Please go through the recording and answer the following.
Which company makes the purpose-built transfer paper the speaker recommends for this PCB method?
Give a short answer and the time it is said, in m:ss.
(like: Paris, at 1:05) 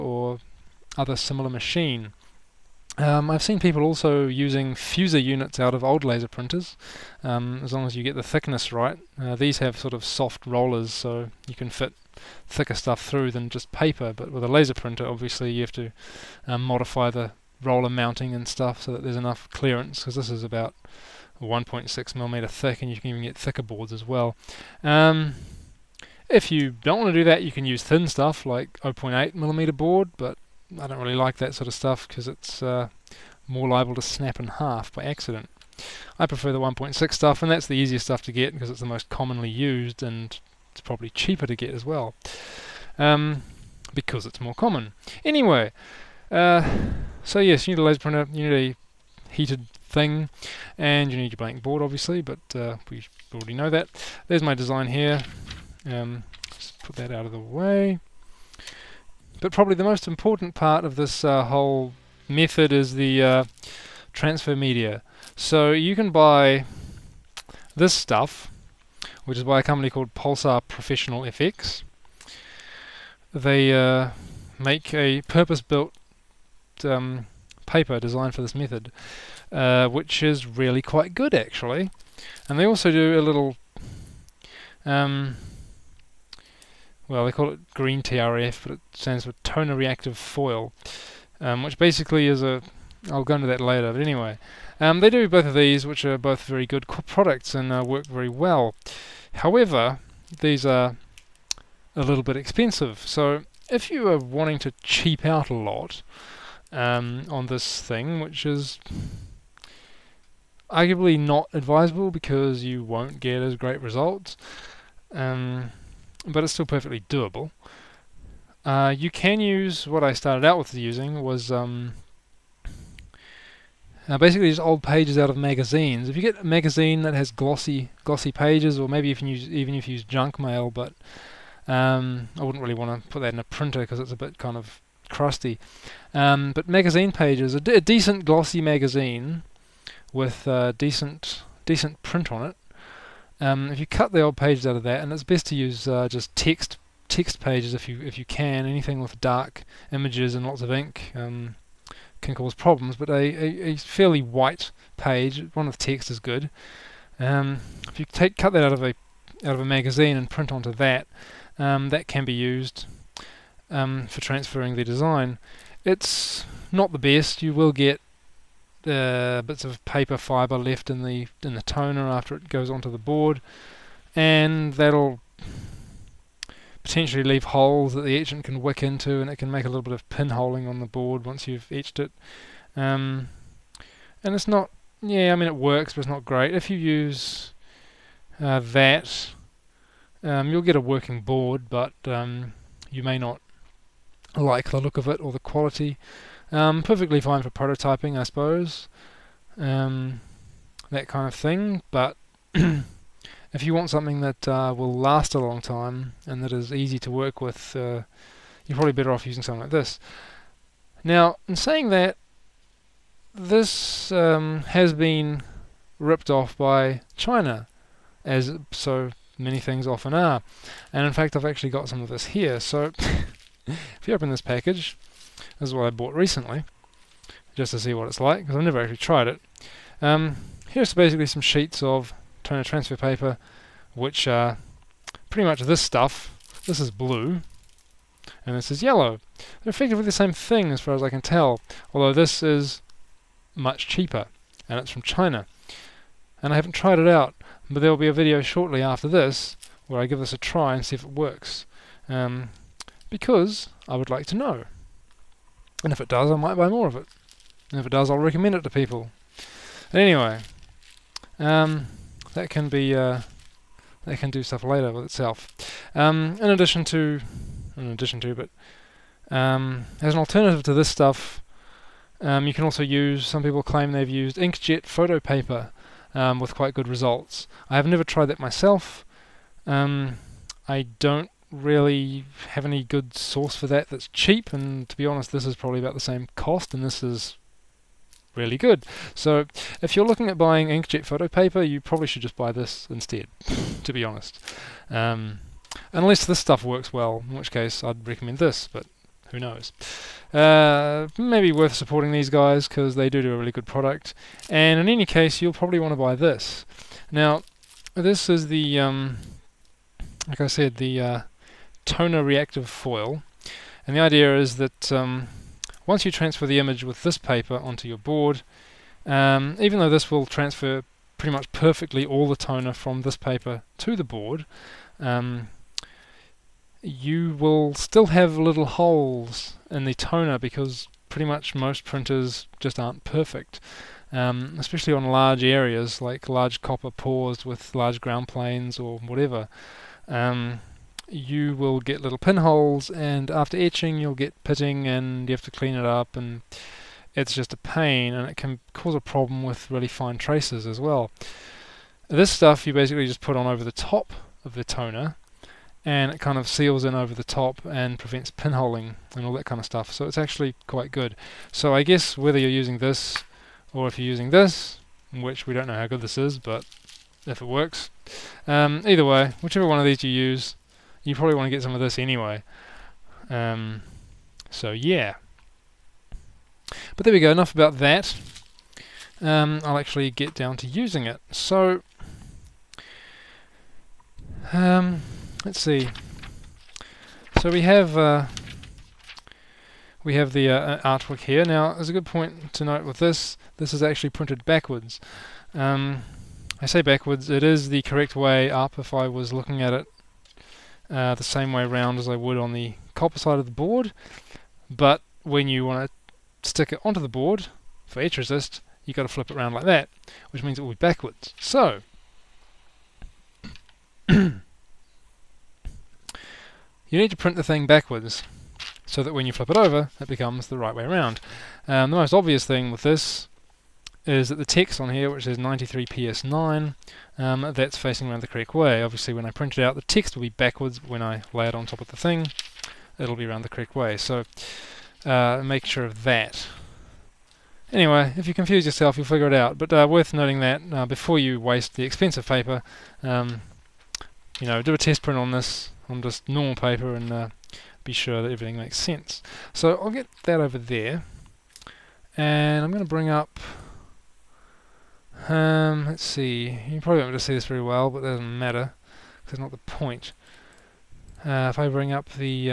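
Pulsar Professional FX, at 1:10.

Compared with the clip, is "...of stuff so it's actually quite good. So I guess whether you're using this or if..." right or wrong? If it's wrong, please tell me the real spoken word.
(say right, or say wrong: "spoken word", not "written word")
right.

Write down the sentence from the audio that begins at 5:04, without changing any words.
And in any case, you'll probably want to buy this.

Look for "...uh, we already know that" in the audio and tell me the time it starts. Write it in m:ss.
0:52.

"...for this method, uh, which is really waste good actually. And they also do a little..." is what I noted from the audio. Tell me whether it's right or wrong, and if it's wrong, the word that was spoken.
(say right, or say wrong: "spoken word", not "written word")
wrong: "quite", not "waste".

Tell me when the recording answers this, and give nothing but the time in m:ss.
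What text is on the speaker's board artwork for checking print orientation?
7:05.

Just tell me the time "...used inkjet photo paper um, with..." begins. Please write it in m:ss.
4:34.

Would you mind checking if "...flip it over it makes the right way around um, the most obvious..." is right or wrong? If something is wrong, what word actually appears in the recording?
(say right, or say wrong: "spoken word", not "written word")
wrong: "becomes", not "makes".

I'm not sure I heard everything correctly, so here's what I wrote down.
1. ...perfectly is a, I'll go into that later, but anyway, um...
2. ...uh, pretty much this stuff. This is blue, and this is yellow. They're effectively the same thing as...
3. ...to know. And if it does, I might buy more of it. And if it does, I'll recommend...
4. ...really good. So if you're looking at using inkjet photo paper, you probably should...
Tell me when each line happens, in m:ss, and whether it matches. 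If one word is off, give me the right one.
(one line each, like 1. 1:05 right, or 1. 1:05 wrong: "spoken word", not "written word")
1. 1:31 wrong: "basically", not "perfectly"
2. 3:54 right
3. 4:14 right
4. 4:48 wrong: "buying", not "using".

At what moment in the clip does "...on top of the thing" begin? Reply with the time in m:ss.
7:11.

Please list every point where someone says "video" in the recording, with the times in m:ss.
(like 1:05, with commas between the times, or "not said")
4:08.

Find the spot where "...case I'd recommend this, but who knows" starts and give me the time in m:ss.
4:57.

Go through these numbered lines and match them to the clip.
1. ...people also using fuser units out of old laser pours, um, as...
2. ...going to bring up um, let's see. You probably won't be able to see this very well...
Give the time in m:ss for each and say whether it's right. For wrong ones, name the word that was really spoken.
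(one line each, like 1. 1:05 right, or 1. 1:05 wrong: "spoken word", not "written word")
1. 0:03 wrong: "printers", not "pours"
2. 7:32 right.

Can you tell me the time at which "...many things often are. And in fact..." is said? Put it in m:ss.
3:39.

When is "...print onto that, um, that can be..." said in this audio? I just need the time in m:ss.
2:40.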